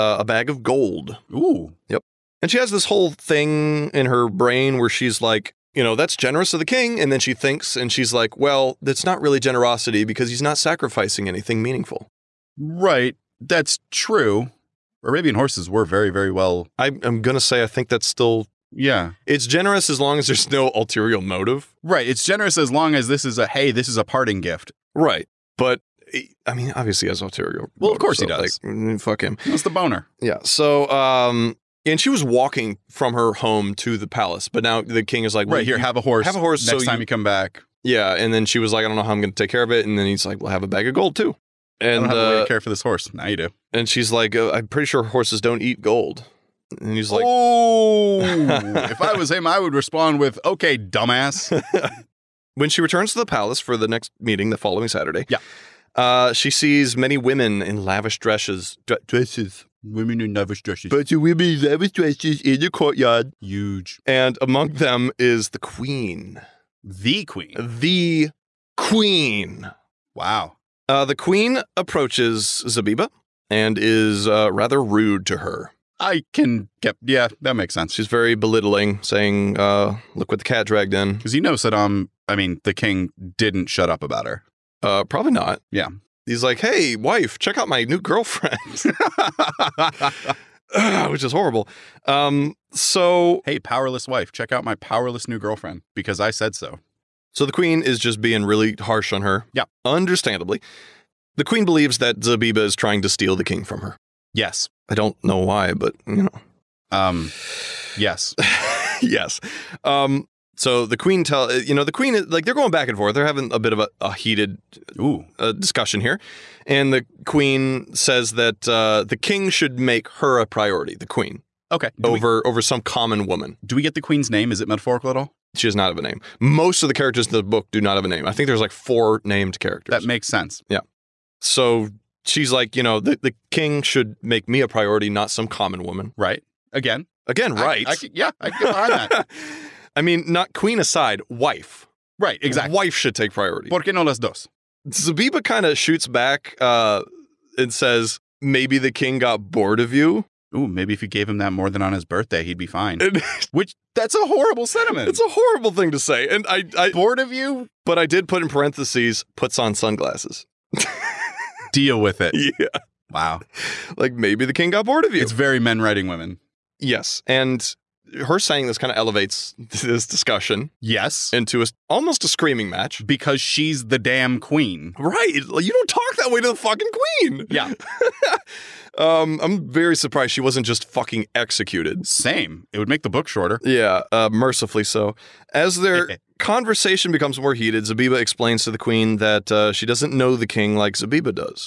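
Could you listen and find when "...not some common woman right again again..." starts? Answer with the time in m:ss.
2:15.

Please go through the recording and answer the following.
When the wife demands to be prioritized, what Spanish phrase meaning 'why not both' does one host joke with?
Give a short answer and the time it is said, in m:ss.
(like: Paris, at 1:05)
¿Por qué no las dos?, at 2:23.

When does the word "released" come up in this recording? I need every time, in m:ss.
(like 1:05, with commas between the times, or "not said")
not said.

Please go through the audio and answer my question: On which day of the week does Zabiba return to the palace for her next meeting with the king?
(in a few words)
Saturday.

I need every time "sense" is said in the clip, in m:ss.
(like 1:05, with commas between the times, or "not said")
1:17, 2:10.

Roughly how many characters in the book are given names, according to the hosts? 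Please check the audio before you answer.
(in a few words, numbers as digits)
4.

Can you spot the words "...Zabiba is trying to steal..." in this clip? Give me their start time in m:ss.
1:42.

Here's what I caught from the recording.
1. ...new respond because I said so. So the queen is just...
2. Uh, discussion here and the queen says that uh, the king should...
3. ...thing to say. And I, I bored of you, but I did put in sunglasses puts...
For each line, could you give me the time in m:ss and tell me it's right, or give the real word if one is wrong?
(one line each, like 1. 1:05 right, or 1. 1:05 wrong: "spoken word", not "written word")
1. 1:35 wrong: "girlfriend", not "respond"
2. 1:55 right
3. 2:35 wrong: "parentheses", not "sunglasses".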